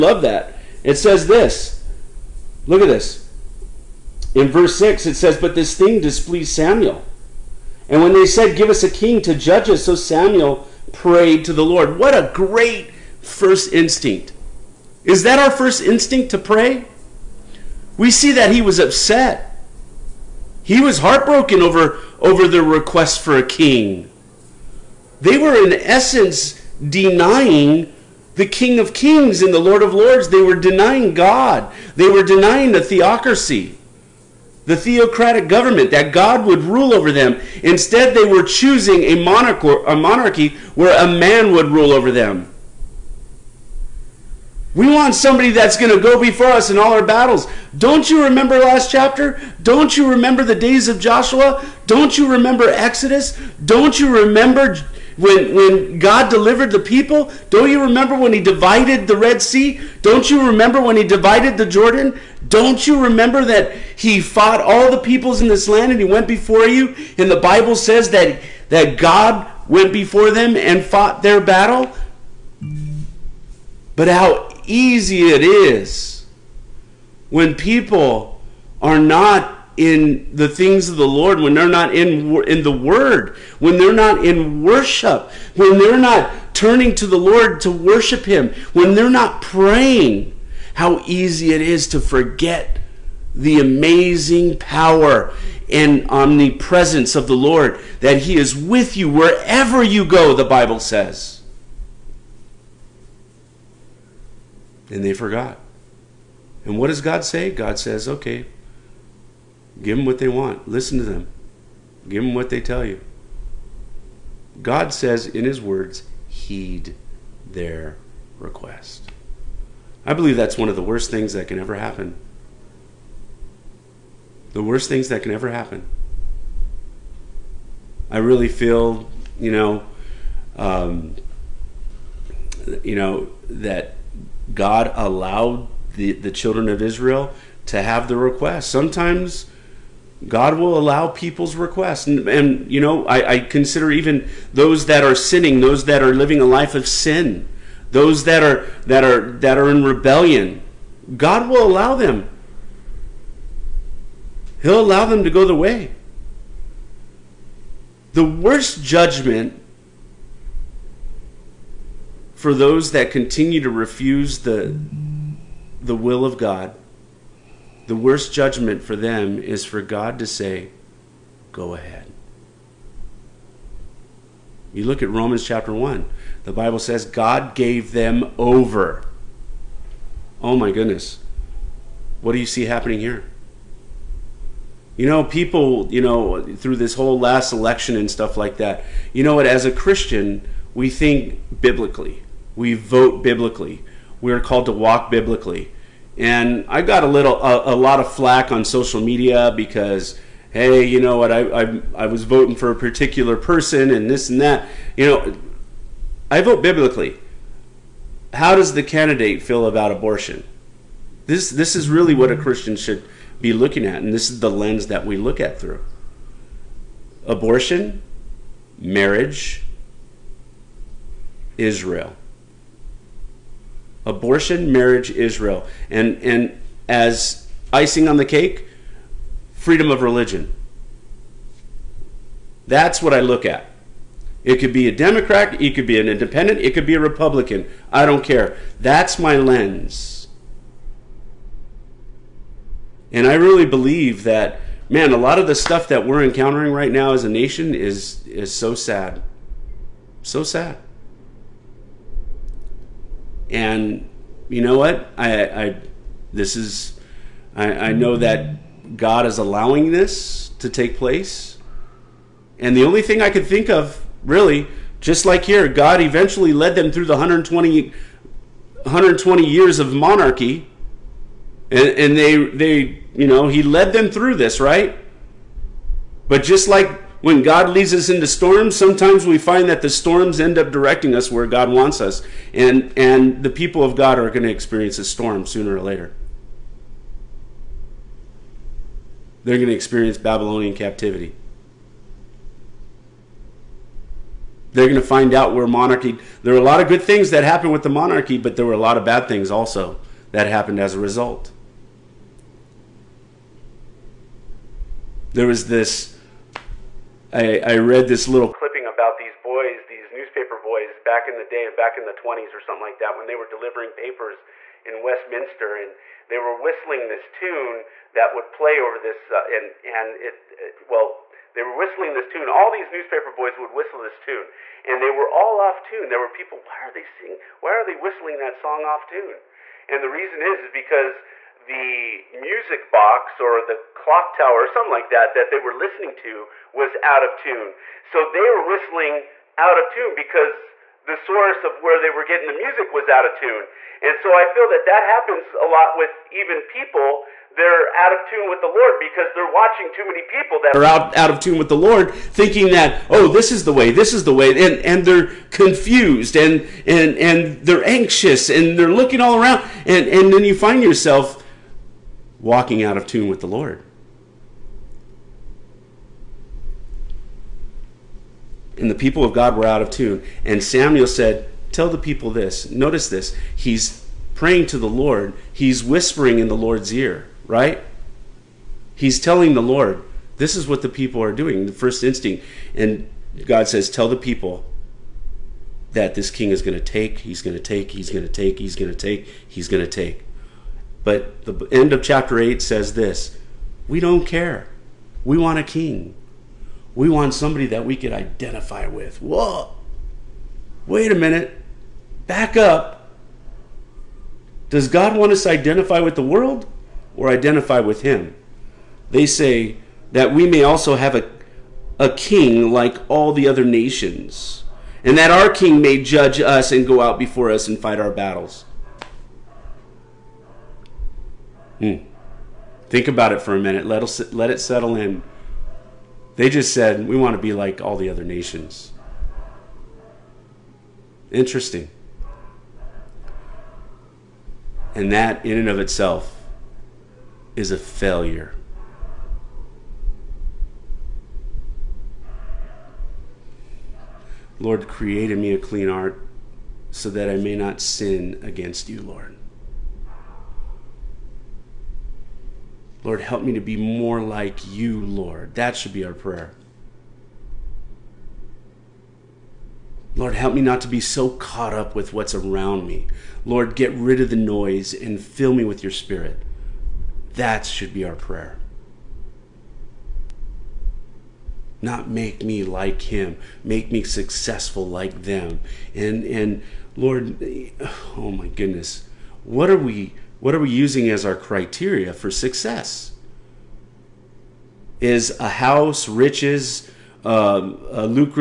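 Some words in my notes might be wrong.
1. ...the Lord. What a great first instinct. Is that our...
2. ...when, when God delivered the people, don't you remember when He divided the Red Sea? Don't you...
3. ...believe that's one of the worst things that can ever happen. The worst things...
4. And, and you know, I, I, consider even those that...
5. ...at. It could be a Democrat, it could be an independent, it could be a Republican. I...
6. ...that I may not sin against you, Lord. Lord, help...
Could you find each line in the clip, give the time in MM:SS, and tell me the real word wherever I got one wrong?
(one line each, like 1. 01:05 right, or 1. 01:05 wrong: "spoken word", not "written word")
1. 00:11 right
2. 00:55 right
3. 02:00 right
4. 02:22 right
5. 03:53 right
6. 07:27 right.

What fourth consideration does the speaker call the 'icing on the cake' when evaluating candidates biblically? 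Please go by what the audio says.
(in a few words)
Freedom of religion.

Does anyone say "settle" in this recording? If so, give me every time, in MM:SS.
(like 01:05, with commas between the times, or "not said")
07:04.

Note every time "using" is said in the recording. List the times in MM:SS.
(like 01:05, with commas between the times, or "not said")
08:00.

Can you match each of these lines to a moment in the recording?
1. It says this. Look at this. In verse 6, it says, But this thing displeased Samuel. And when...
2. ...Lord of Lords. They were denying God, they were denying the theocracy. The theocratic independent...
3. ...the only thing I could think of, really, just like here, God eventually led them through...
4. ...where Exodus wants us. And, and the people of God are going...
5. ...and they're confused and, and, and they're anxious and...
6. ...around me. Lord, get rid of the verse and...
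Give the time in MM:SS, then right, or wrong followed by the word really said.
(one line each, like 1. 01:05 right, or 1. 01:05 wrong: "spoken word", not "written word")
1. 00:00 right
2. 00:29 wrong: "government", not "independent"
3. 04:22 right
4. 04:41 wrong: "God", not "Exodus"
5. 05:54 right
6. 07:42 wrong: "noise", not "verse".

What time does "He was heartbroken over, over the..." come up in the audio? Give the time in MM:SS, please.
00:20.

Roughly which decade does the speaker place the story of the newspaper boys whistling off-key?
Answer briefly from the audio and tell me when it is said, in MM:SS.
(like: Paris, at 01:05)
The 1920s, at 05:12.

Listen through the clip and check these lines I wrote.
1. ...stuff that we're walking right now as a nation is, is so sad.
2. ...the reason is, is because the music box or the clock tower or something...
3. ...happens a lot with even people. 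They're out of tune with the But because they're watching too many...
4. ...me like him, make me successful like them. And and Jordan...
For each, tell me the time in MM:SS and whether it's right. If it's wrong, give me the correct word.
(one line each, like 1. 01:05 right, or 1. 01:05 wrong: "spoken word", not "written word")
1. 04:05 wrong: "encountering", not "walking"
2. 05:30 right
3. 05:45 wrong: "Lord", not "But"
4. 07:52 wrong: "Lord", not "Jordan".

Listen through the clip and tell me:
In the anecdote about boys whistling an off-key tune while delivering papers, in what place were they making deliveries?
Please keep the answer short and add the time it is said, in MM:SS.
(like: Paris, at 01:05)
Westminster, at 05:15.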